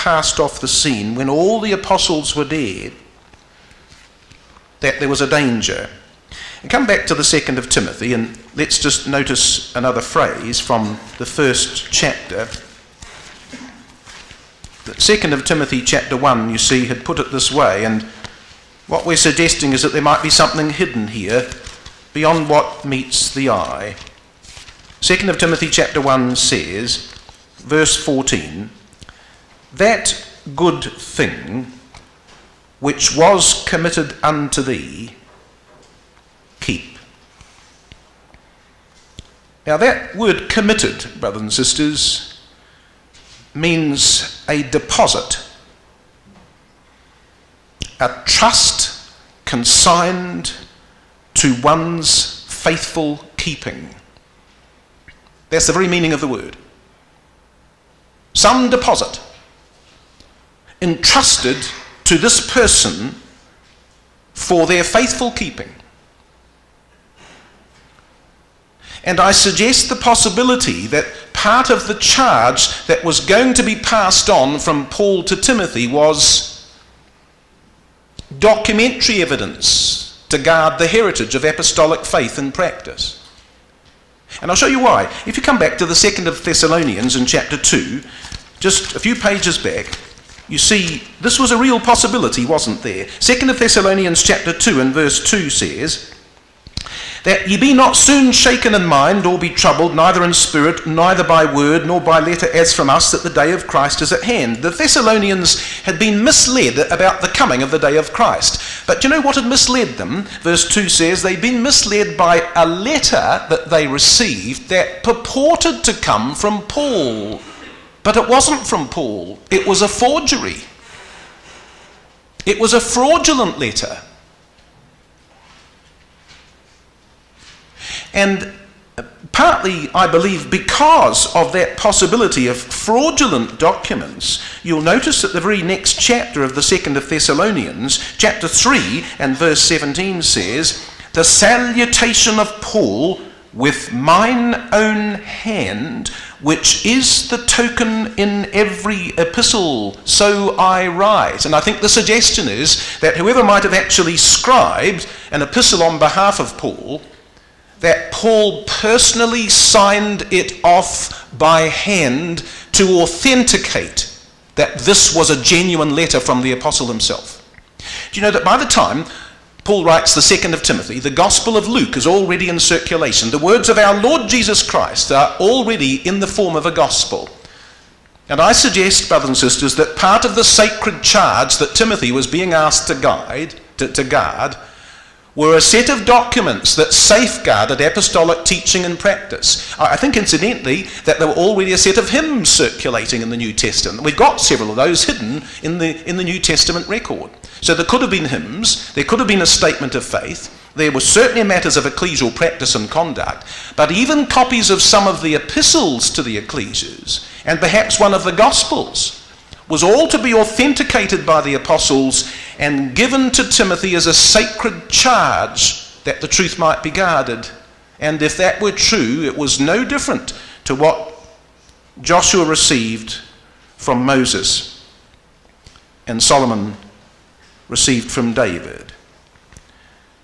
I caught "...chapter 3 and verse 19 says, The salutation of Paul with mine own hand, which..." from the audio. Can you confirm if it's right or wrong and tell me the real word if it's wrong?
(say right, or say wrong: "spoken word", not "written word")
wrong: "17", not "19".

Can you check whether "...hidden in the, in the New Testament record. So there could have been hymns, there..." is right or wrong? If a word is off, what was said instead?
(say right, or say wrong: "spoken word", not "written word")
right.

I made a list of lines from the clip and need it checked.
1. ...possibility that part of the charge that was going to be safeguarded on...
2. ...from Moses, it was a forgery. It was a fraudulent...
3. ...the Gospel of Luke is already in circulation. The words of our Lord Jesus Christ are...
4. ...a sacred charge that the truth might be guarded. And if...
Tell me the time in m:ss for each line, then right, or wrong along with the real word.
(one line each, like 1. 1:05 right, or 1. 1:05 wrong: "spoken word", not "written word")
1. 1:09 wrong: "passed", not "safeguarded"
2. 1:58 wrong: "Paul", not "Moses"
3. 2:50 right
4. 3:34 right.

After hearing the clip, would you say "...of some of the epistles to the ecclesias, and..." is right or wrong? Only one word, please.
right.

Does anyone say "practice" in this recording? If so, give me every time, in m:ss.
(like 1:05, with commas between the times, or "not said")
1:22, 3:08, 3:22.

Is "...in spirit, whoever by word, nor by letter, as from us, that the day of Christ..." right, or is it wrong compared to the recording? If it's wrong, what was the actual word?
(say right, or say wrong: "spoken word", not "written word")
wrong: "neither", not "whoever".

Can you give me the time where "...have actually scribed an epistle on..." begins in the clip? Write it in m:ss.
2:33.